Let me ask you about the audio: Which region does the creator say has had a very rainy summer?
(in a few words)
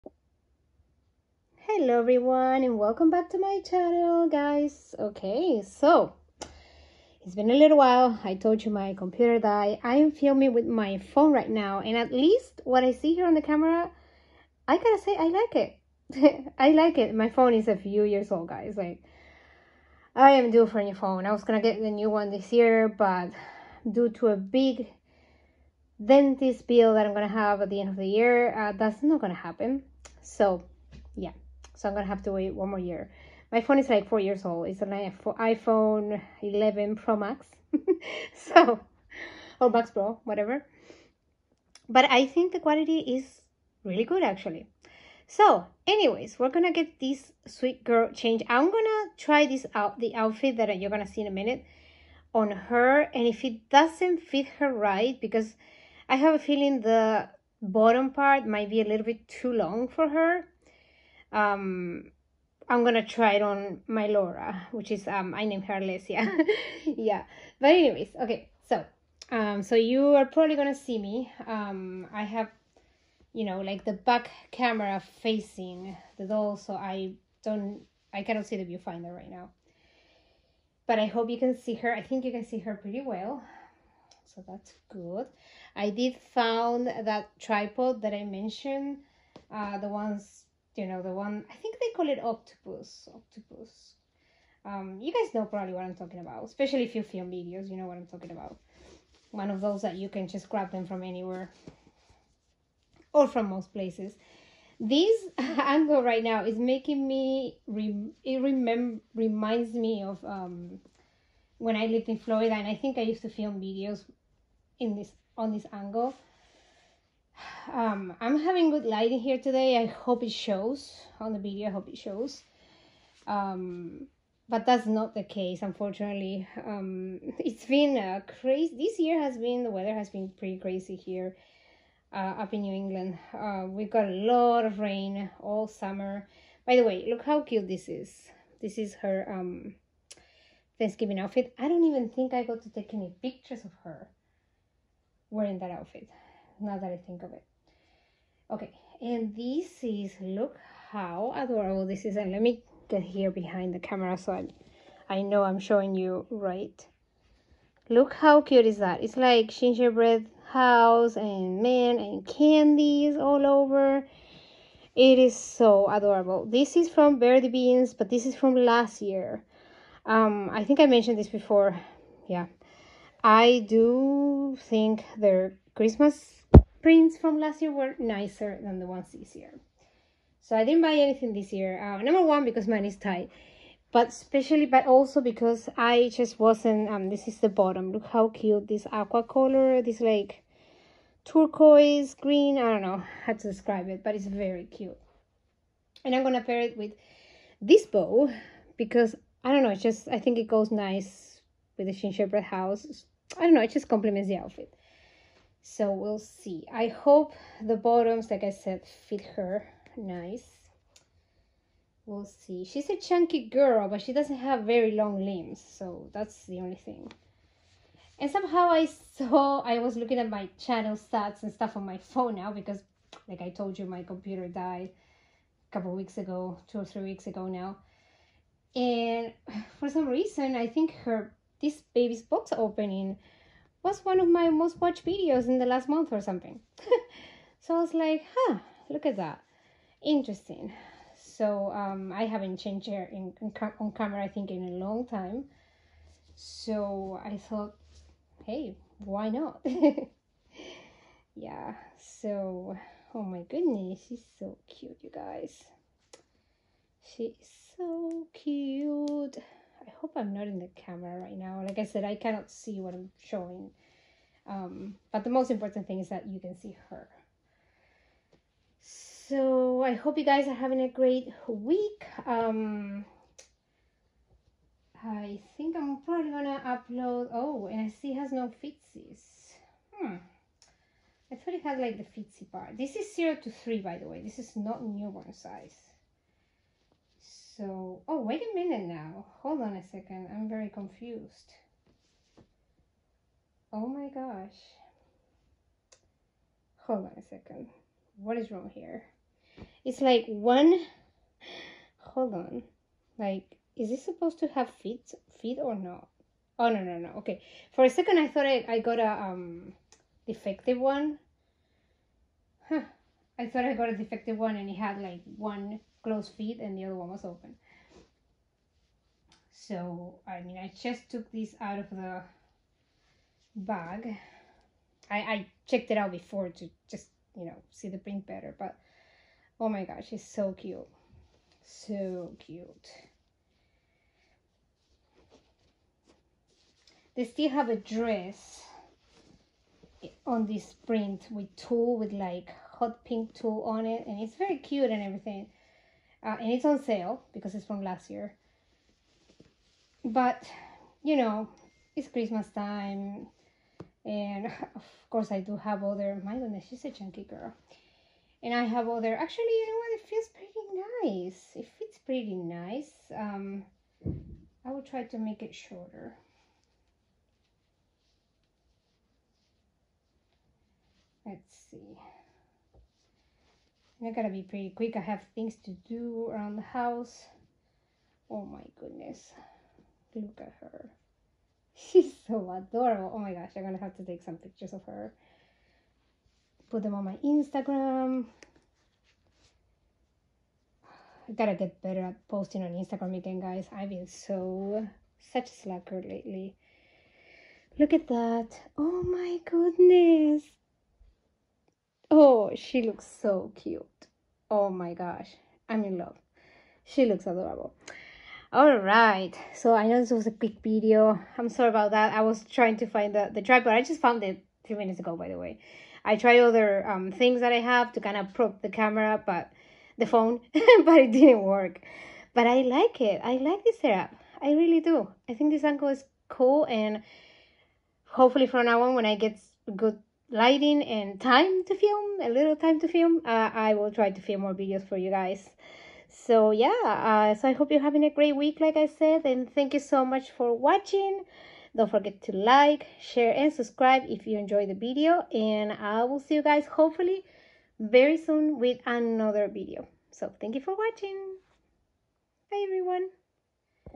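New England.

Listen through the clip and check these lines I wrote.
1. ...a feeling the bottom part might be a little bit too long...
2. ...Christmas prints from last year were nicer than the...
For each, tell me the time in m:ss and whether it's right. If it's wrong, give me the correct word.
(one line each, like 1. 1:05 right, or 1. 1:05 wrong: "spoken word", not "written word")
1. 0:56 right
2. 2:55 right.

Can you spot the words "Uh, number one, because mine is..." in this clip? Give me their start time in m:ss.
3:01.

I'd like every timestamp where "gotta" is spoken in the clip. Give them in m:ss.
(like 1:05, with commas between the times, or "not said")
0:14, 6:14, 6:31.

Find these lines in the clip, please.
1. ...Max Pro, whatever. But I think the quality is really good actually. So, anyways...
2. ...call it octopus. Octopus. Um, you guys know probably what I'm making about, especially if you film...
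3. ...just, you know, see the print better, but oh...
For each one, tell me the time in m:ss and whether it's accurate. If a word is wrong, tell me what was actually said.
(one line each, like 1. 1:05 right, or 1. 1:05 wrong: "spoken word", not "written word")
1. 0:39 right
2. 1:31 wrong: "talking", not "making"
3. 5:26 right.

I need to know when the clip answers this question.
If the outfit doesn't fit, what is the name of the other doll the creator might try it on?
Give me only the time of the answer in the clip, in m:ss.
1:05.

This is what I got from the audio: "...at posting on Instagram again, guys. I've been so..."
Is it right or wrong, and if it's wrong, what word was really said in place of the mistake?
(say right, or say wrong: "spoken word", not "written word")
right.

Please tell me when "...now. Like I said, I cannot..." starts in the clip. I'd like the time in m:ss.
4:21.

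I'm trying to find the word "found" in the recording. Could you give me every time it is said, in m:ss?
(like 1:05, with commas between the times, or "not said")
1:26, 6:54.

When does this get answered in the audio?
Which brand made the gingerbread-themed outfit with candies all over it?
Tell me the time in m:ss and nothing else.
2:47.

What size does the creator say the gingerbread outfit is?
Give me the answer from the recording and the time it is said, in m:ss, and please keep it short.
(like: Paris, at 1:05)
0 to 3, at 4:43.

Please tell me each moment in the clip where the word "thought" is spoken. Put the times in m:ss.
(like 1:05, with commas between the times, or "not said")
4:07, 4:41, 5:08, 5:13.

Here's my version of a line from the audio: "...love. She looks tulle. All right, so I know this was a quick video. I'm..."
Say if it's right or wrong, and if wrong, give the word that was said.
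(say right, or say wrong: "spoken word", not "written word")
wrong: "adorable", not "tulle".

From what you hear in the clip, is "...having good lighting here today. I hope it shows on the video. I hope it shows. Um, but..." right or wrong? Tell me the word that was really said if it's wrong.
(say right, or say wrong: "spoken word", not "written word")
right.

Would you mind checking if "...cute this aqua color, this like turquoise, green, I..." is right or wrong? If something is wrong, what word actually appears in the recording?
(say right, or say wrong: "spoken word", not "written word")
right.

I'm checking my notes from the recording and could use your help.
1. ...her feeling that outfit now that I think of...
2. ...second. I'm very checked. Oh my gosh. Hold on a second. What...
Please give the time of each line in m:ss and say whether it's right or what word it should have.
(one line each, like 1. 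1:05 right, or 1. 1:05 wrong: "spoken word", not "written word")
1. 2:23 wrong: "wearing", not "feeling"
2. 4:49 wrong: "confused", not "checked".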